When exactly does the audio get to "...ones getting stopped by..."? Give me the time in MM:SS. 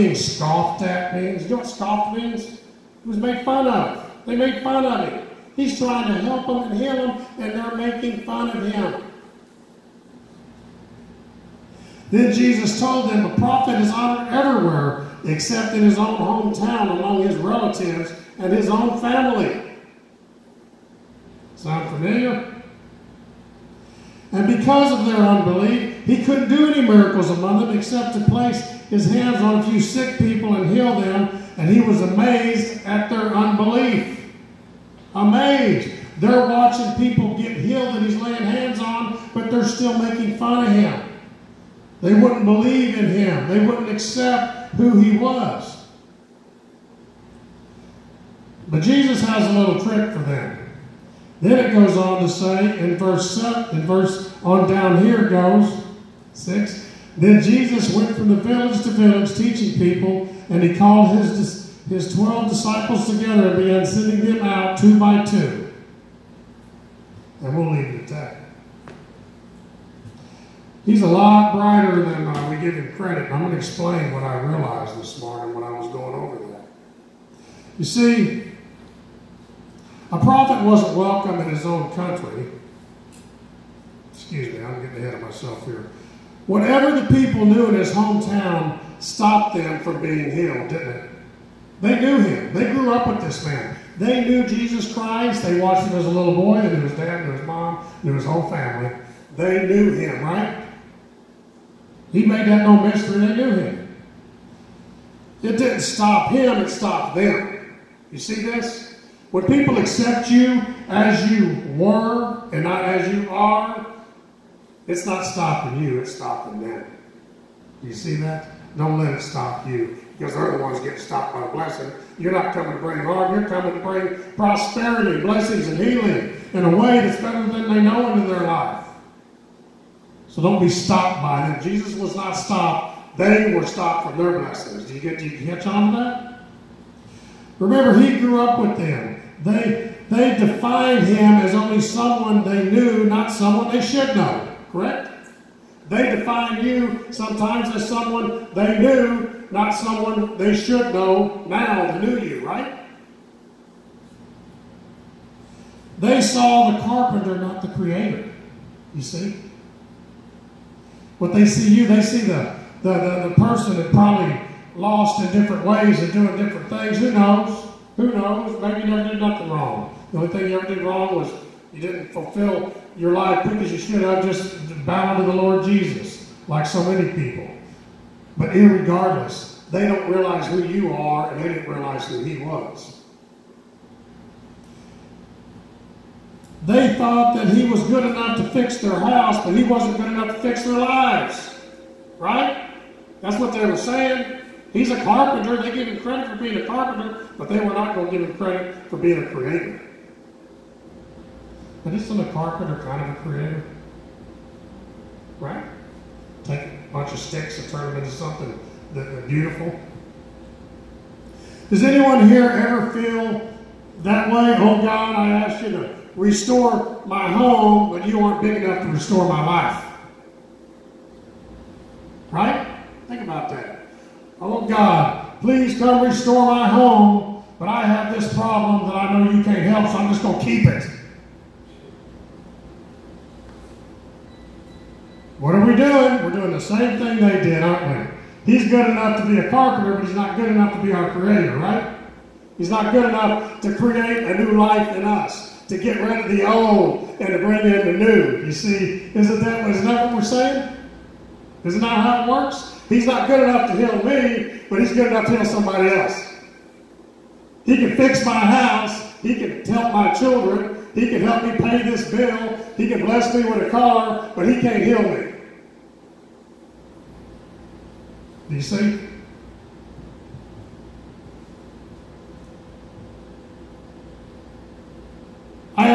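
02:00.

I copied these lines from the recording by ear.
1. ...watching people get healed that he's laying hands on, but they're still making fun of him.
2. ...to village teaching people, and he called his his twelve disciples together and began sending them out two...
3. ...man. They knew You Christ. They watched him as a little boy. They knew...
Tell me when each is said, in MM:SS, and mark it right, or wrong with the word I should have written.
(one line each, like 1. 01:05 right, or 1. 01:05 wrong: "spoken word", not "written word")
1. 00:36 right
2. 00:58 right
3. 01:33 wrong: "Jesus", not "You".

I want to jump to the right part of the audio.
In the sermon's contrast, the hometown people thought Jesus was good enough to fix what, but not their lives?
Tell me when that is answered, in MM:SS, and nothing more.
03:08.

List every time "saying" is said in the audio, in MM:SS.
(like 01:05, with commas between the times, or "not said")
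03:13, 04:10.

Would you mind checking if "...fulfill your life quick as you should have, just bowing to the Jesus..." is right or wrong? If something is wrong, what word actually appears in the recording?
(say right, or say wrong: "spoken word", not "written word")
wrong: "Lord", not "Jesus".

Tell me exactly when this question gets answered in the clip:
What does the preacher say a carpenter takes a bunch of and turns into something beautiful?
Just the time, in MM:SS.
03:27.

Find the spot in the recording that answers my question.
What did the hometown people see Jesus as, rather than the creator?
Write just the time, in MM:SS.
02:36.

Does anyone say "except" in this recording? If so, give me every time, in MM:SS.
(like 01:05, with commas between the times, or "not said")
00:15, 00:27.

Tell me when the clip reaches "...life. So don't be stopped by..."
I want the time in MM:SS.
02:08.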